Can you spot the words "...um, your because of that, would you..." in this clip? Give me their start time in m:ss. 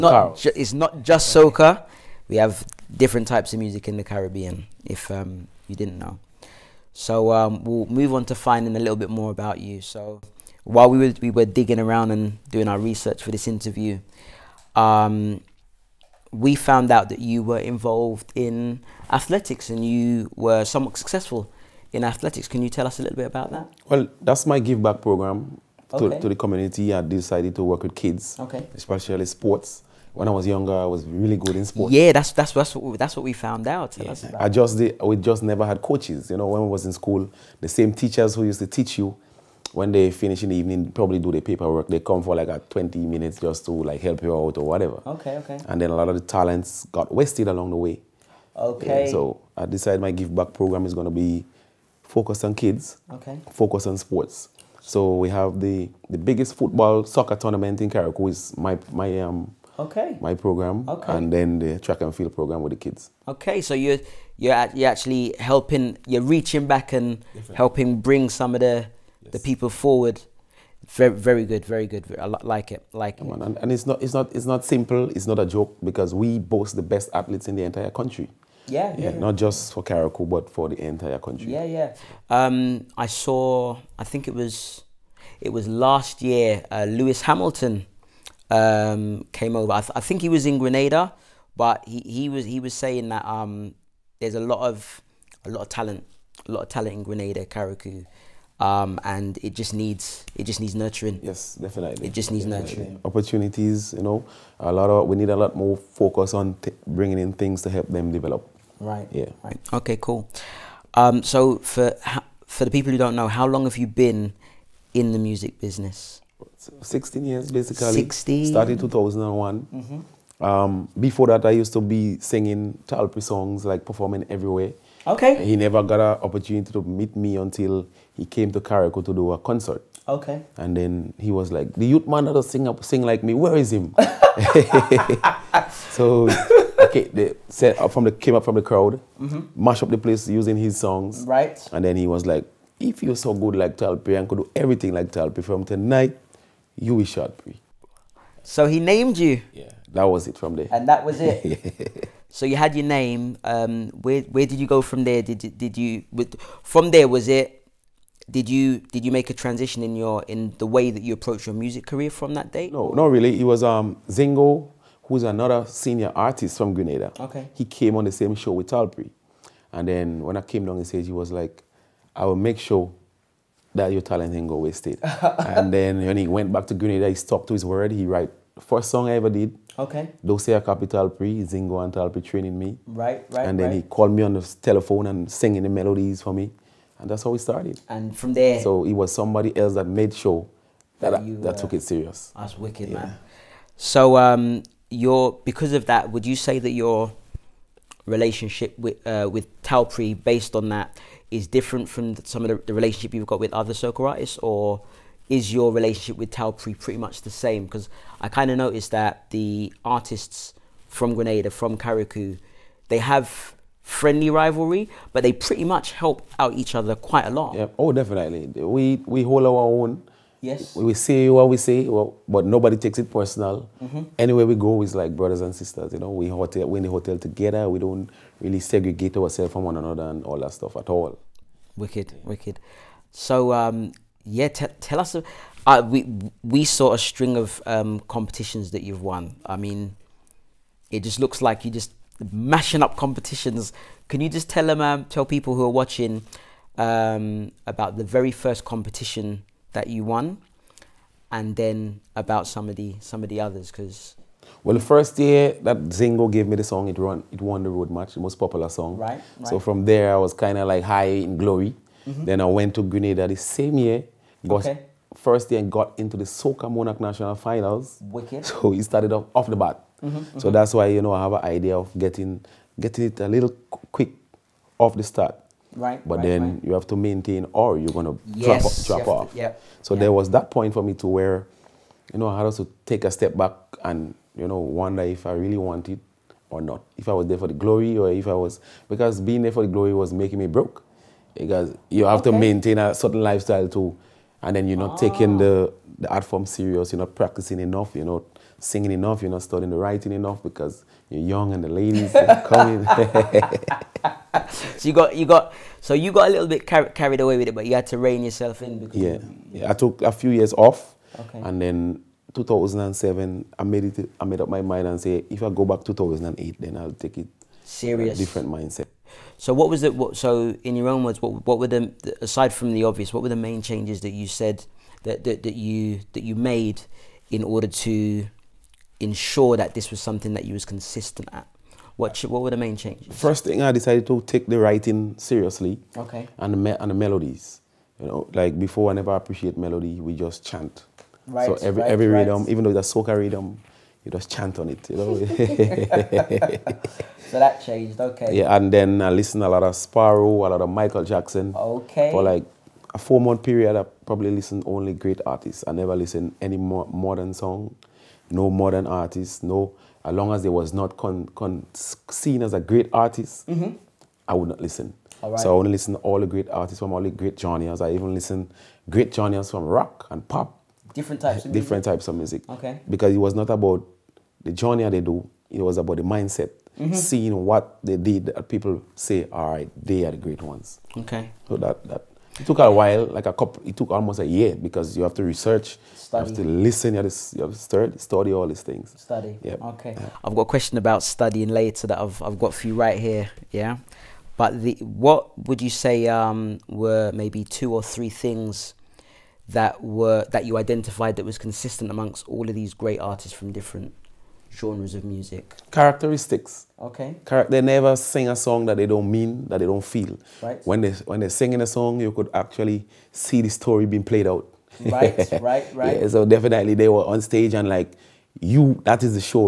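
3:14.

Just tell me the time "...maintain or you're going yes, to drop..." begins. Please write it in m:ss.
4:36.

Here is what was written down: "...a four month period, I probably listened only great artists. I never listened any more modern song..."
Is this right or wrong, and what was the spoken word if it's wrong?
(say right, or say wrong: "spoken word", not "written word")
right.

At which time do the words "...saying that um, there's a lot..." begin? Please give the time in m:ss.
1:32.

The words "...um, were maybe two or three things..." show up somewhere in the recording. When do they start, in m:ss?
6:36.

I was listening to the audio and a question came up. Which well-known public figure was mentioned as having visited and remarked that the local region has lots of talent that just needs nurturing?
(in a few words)
Lewis Hamilton.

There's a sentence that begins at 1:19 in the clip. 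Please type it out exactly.
Not just for Carriacou, but for the entire country.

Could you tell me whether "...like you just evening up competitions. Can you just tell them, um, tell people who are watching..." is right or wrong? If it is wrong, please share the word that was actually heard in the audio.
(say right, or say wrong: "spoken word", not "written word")
wrong: "mashing", not "evening".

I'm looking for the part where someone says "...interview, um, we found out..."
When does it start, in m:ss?
0:13.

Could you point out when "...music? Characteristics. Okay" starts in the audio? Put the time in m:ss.
6:45.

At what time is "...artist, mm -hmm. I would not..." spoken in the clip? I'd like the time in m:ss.
6:02.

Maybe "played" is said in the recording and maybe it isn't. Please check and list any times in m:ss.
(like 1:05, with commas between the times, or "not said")
6:54.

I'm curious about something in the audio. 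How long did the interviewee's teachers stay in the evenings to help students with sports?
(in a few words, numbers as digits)
20 minutes.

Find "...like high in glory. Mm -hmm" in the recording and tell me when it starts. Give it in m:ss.
4:20.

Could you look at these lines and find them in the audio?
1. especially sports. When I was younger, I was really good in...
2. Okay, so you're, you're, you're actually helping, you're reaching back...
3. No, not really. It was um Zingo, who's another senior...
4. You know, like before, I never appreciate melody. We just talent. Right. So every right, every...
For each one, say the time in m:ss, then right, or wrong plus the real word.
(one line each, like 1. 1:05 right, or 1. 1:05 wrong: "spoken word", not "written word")
1. 0:28 right
2. 1:03 right
3. 2:42 right
4. 5:37 wrong: "chant", not "talent".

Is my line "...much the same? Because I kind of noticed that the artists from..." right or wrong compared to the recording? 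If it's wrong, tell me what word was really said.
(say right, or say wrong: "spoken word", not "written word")
right.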